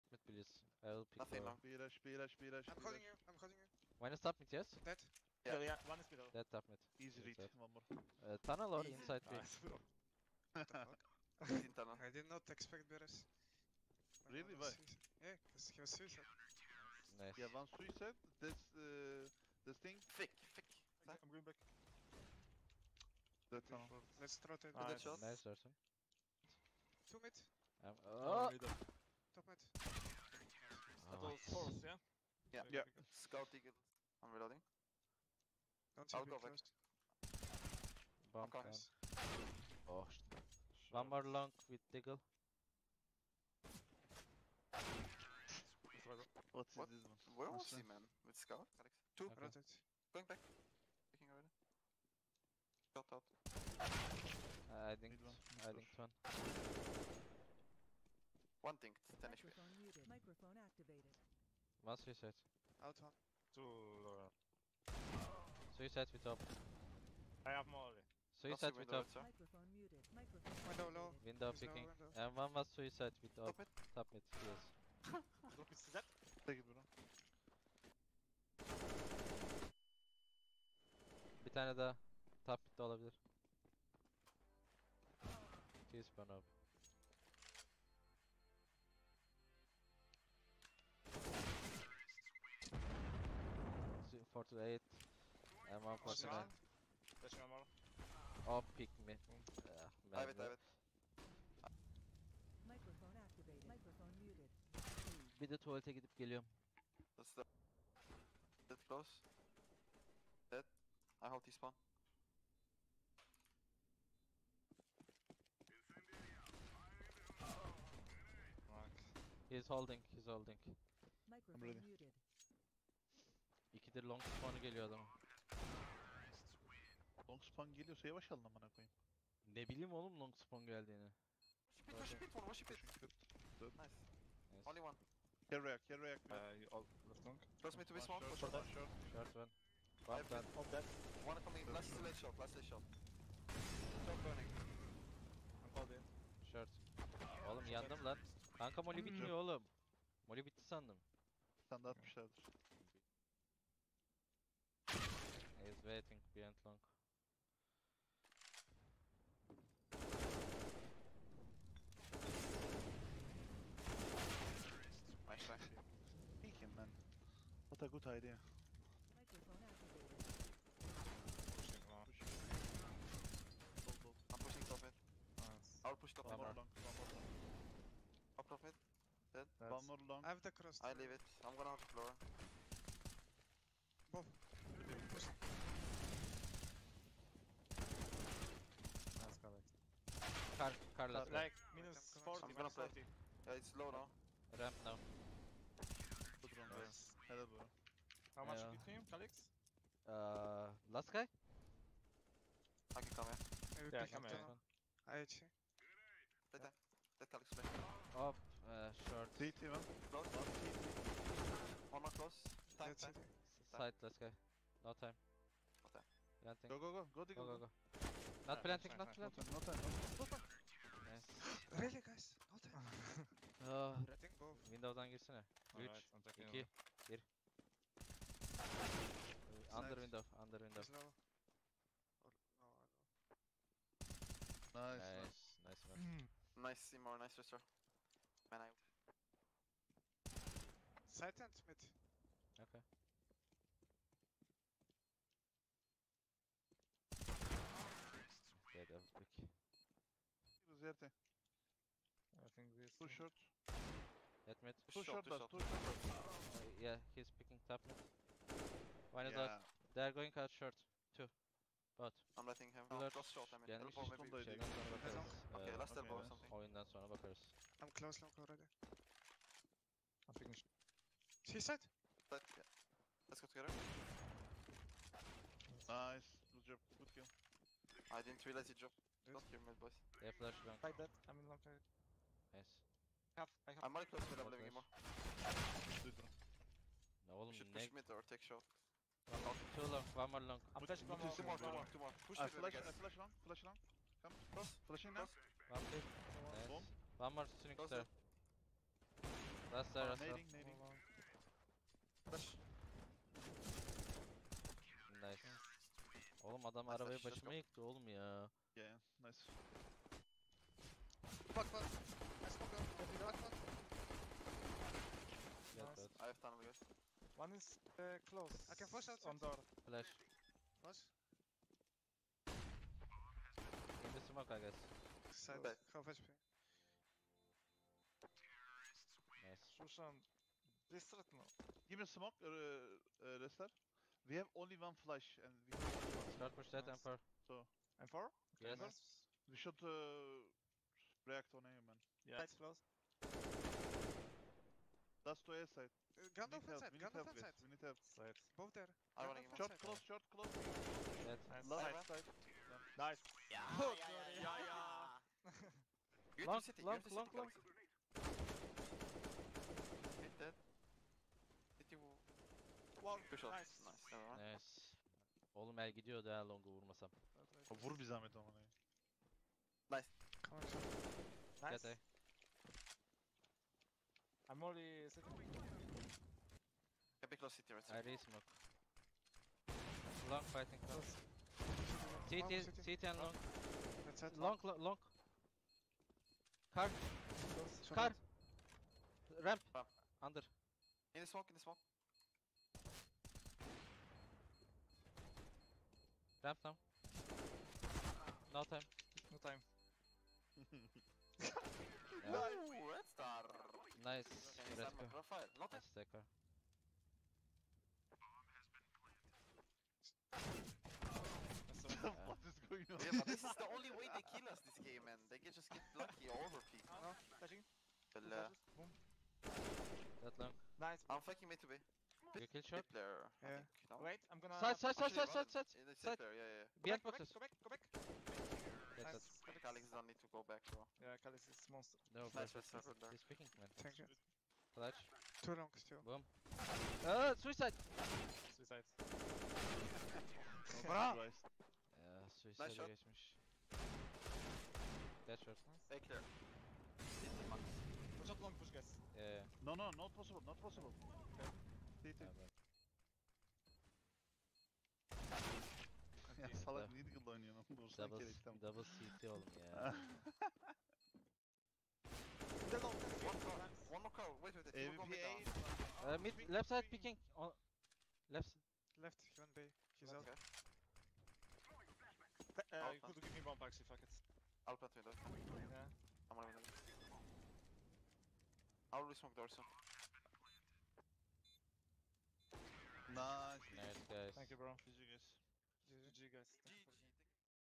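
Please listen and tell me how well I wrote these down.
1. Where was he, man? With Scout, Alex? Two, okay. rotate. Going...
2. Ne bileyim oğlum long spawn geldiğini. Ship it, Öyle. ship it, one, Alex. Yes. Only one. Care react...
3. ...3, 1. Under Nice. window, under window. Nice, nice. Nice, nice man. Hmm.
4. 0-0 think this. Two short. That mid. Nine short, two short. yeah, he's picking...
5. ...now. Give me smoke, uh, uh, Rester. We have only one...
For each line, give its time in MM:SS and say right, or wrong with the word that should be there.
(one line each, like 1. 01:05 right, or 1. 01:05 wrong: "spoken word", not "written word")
1. 00:47 right
2. 02:09 wrong: "Nice", not "Alex"
3. 03:46 wrong: "2", not "3"
4. 04:11 wrong: "Two", not "Nine"
5. 05:31 right.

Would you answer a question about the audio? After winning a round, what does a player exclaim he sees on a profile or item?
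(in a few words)
red star.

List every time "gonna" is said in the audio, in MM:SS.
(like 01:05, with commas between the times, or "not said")
03:01, 03:12, 07:04.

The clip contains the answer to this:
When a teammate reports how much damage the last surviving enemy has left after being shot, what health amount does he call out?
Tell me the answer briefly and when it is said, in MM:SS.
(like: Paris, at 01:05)
10 HP, at 00:59.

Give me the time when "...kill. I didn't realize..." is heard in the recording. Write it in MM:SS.
04:37.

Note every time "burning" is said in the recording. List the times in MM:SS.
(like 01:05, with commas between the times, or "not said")
02:24.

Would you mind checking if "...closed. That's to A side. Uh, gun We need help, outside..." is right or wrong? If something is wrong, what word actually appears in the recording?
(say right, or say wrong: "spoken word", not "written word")
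right.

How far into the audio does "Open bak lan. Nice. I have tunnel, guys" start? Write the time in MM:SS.
05:13.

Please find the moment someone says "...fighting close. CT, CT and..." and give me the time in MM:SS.
06:20.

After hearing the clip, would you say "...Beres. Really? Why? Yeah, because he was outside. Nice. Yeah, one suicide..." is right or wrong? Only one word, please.
wrong.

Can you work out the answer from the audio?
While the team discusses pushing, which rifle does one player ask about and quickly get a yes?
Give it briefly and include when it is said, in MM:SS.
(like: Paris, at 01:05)
M4, at 05:38.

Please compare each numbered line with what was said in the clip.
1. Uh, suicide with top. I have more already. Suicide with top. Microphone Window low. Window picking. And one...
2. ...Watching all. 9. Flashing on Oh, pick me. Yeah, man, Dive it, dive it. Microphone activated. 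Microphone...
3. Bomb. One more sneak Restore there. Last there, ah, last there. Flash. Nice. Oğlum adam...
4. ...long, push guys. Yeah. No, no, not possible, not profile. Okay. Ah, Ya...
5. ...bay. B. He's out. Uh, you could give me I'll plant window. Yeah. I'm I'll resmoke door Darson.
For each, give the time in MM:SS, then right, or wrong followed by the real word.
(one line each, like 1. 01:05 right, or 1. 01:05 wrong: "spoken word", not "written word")
1. 01:04 right
2. 01:36 wrong: "7", not "9"
3. 04:56 wrong: "Close", not "Restore"
4. 07:28 wrong: "possible", not "profile"
5. 07:49 wrong: "Nice", not "Darson".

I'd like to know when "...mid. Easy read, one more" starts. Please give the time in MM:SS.
00:06.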